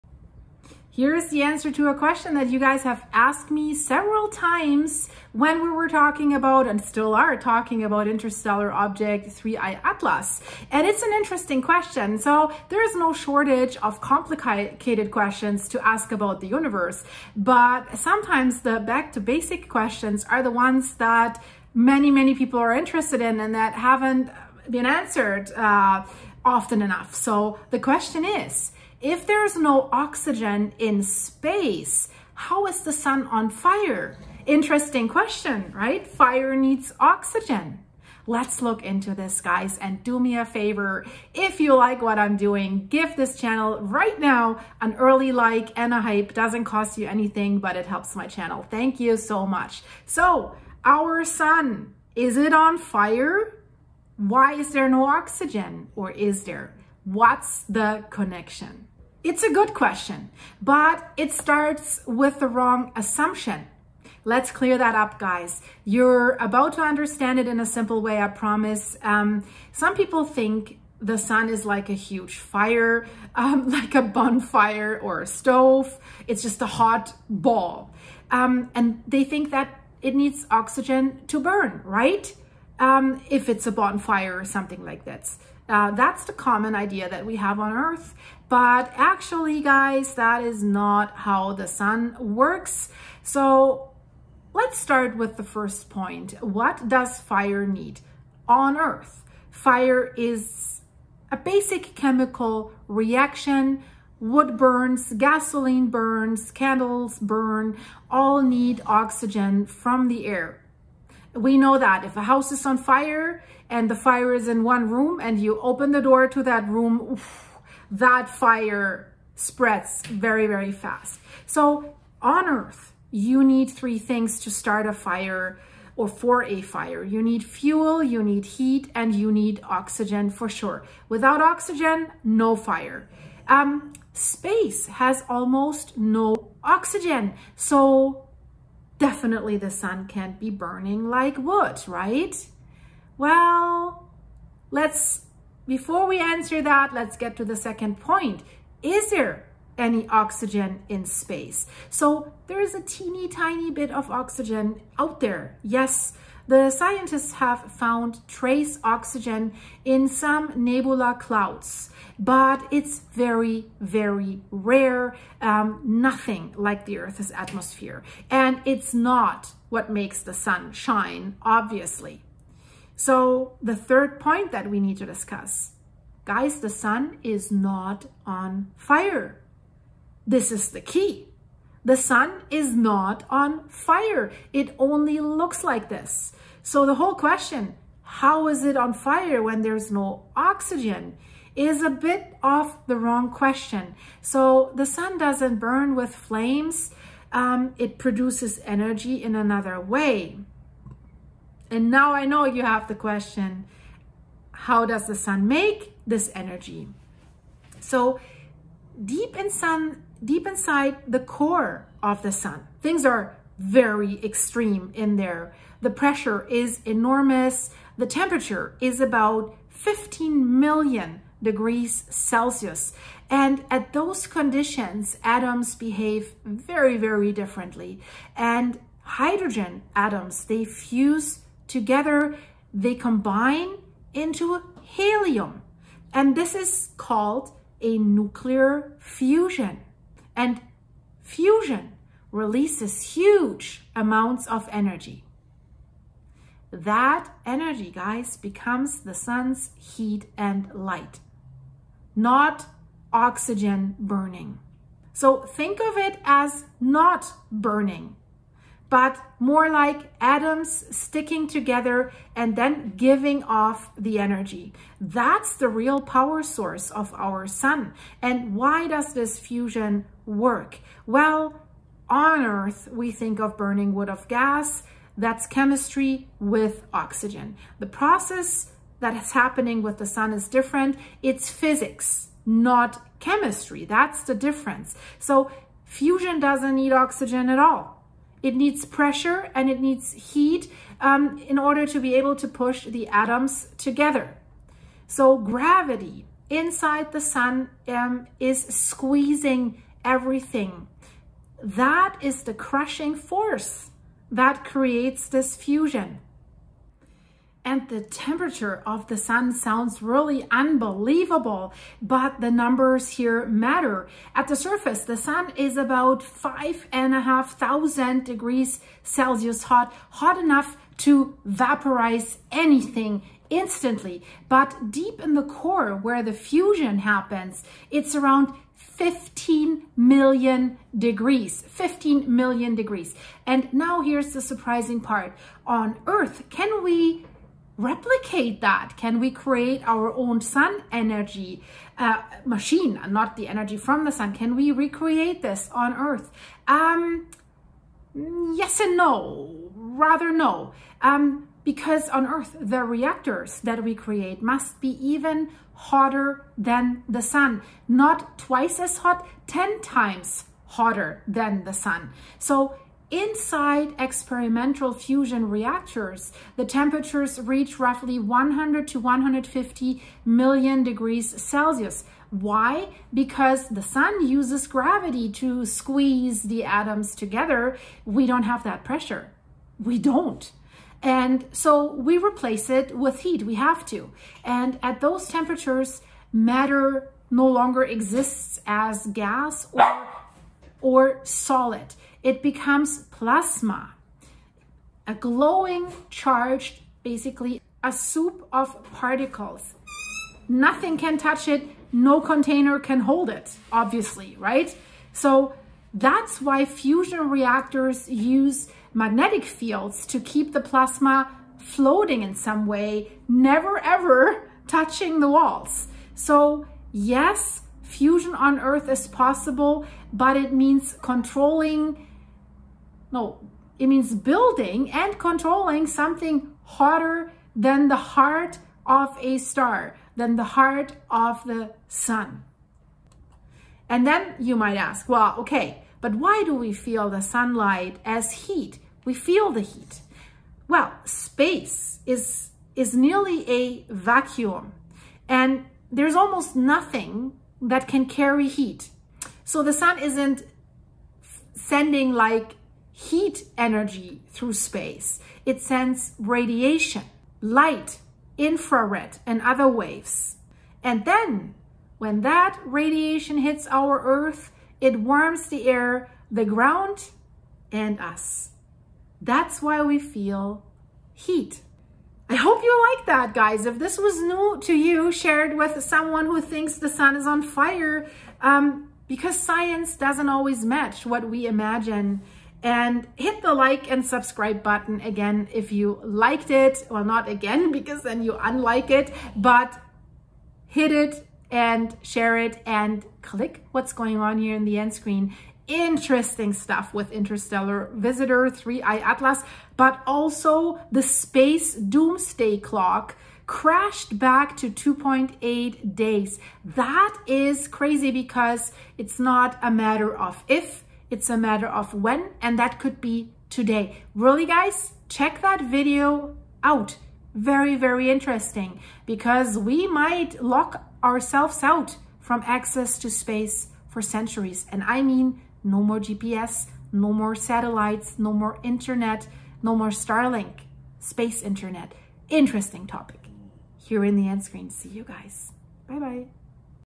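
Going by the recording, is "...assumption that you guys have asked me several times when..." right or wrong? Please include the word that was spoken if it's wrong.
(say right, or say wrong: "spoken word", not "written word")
wrong: "question", not "assumption".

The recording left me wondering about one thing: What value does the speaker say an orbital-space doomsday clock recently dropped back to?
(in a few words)
2.8 days.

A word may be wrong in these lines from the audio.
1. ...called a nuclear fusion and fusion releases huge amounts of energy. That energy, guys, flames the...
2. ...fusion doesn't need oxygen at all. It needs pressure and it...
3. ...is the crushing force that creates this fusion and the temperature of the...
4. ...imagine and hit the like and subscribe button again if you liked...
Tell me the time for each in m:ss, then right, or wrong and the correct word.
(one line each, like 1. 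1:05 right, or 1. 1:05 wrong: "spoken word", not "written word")
1. 3:56 wrong: "becomes", not "flames"
2. 4:45 right
3. 5:02 right
4. 8:01 right.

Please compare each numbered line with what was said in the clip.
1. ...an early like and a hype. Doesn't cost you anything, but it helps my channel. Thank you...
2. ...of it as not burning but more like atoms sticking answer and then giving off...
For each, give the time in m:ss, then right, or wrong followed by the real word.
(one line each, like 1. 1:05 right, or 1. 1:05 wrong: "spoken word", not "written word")
1. 0:44 right
2. 4:15 wrong: "together", not "answer".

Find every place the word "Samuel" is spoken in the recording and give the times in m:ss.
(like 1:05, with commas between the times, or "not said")
not said.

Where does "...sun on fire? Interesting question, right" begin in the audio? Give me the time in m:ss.
0:32.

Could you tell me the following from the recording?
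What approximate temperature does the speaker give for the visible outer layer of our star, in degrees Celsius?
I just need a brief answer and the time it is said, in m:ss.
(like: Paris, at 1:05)
5,500 degrees, at 5:16.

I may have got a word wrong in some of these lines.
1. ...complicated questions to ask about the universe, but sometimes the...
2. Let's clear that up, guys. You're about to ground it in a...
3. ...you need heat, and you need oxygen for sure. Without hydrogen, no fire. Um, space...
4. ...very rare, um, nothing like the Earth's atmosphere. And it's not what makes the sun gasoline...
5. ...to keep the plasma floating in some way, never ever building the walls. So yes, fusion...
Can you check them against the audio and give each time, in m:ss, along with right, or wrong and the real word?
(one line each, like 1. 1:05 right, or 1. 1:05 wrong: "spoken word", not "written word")
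1. 0:14 right
2. 1:04 wrong: "understand", not "ground"
3. 2:08 wrong: "oxygen", not "hydrogen"
4. 2:43 wrong: "shine", not "gasoline"
5. 6:50 wrong: "touching", not "building".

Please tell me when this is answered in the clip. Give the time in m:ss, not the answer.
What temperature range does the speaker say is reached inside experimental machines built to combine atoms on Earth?
6:08.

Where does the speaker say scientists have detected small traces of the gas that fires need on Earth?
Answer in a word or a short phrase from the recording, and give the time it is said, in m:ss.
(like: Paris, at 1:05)
nebula clouds, at 2:40.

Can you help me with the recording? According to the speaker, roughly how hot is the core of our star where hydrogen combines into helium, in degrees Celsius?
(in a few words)
15 million degrees.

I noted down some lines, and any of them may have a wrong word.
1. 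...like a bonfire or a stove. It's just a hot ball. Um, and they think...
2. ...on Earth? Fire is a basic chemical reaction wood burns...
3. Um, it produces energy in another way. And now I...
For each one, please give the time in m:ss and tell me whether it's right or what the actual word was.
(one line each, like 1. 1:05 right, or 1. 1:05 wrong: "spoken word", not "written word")
1. 1:13 right
2. 1:38 right
3. 3:17 right.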